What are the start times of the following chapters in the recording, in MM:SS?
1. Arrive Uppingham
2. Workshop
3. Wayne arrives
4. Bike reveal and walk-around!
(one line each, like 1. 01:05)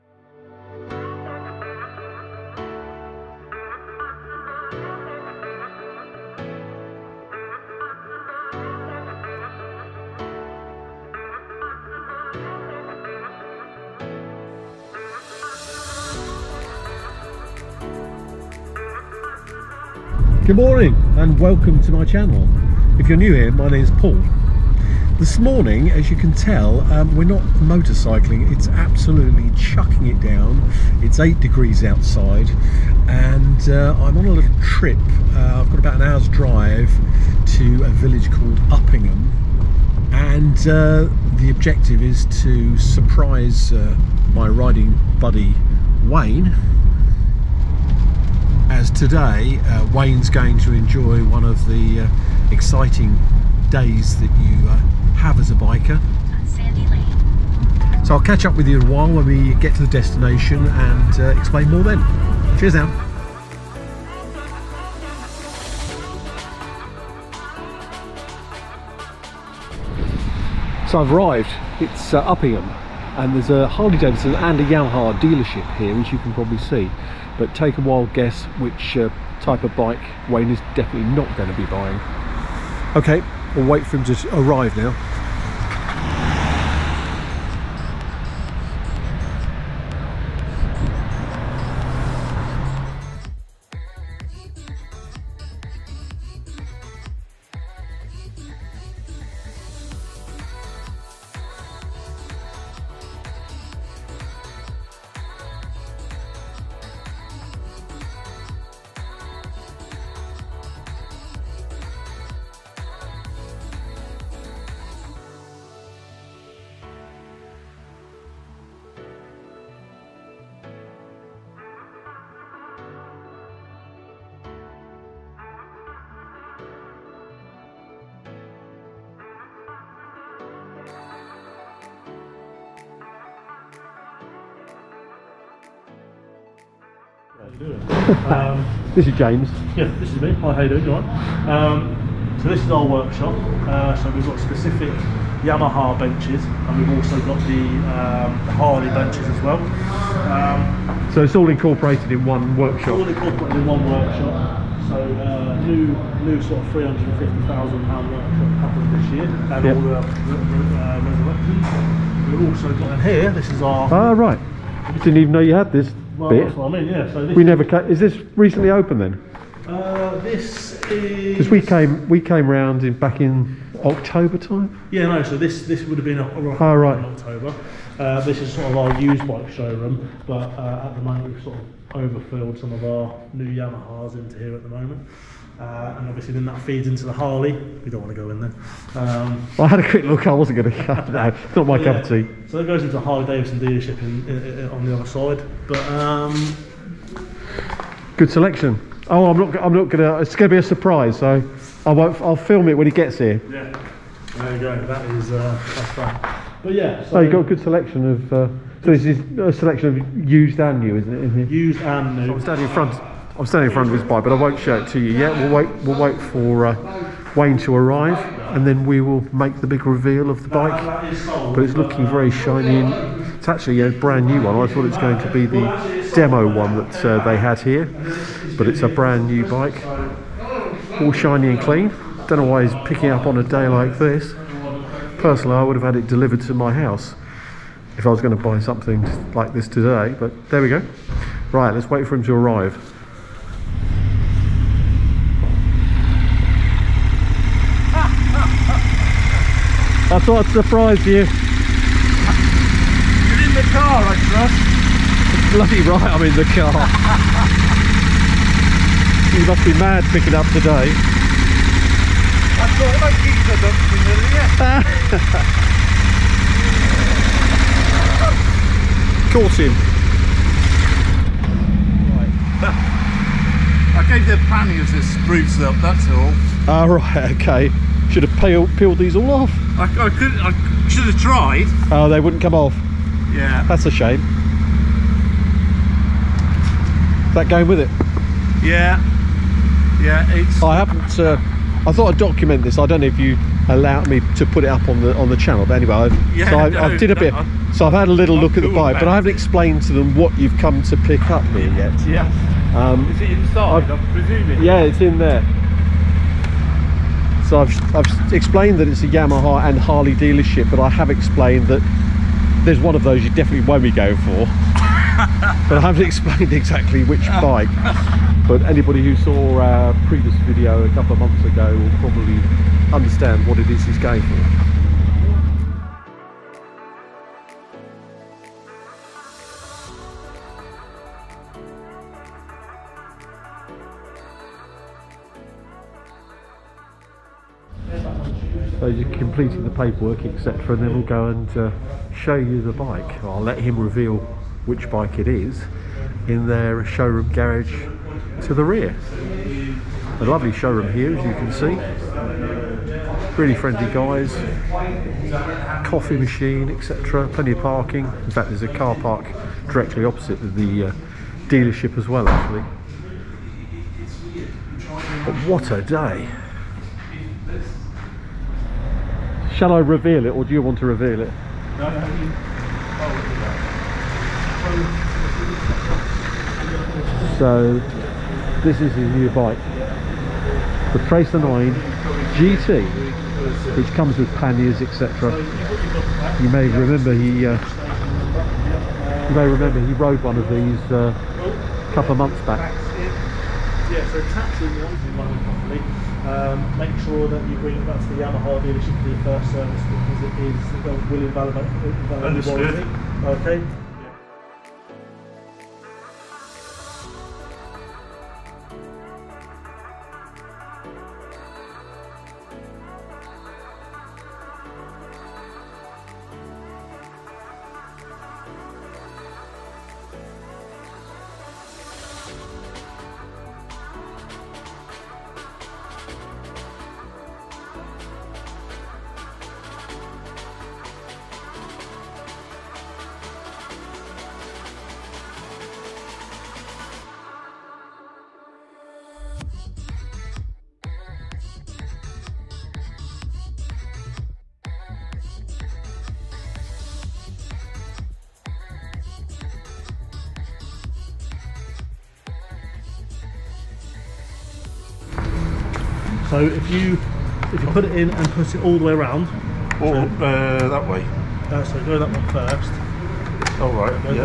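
1. 01:03
2. 02:15
3. 04:02
4. 06:07.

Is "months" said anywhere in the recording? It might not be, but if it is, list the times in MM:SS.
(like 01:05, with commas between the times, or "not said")
05:21, 06:32.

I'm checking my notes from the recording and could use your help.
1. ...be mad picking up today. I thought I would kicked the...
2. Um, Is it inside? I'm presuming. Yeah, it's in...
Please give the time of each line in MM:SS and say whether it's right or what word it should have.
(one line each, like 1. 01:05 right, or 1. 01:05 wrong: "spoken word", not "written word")
1. 04:19 right
2. 05:02 right.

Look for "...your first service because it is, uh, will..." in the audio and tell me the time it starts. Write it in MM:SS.
06:39.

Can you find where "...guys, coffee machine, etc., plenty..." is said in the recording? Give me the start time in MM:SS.
05:53.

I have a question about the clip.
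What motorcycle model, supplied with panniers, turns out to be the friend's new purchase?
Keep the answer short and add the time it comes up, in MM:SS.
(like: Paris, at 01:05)
Tracer 9 GT, at 06:21.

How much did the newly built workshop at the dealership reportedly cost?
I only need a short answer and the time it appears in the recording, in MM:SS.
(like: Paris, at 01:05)
£350,000, at 02:36.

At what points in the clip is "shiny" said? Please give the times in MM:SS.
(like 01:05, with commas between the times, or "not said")
03:42, 03:51.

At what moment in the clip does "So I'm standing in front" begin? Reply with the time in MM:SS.
03:32.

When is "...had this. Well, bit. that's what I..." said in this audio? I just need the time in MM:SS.
02:45.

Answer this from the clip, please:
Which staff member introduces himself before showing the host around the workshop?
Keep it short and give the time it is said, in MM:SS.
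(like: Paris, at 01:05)
James, at 02:19.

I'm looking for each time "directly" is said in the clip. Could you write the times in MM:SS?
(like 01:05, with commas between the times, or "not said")
05:59.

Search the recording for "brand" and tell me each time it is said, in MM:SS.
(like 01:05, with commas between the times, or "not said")
03:43, 03:48.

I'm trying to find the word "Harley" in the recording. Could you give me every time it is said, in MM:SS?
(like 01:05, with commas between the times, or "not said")
01:13, 02:28, 03:07, 03:12, 05:09.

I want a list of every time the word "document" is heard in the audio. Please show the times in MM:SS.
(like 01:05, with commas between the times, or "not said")
04:52.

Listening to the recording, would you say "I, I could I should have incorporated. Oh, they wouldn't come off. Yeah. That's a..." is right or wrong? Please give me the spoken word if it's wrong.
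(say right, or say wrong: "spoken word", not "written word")
wrong: "tried", not "incorporated".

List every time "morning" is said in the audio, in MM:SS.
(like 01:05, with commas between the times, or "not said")
00:20, 00:25.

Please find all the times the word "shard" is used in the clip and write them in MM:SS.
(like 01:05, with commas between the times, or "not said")
not said.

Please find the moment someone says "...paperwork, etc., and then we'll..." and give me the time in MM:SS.
05:39.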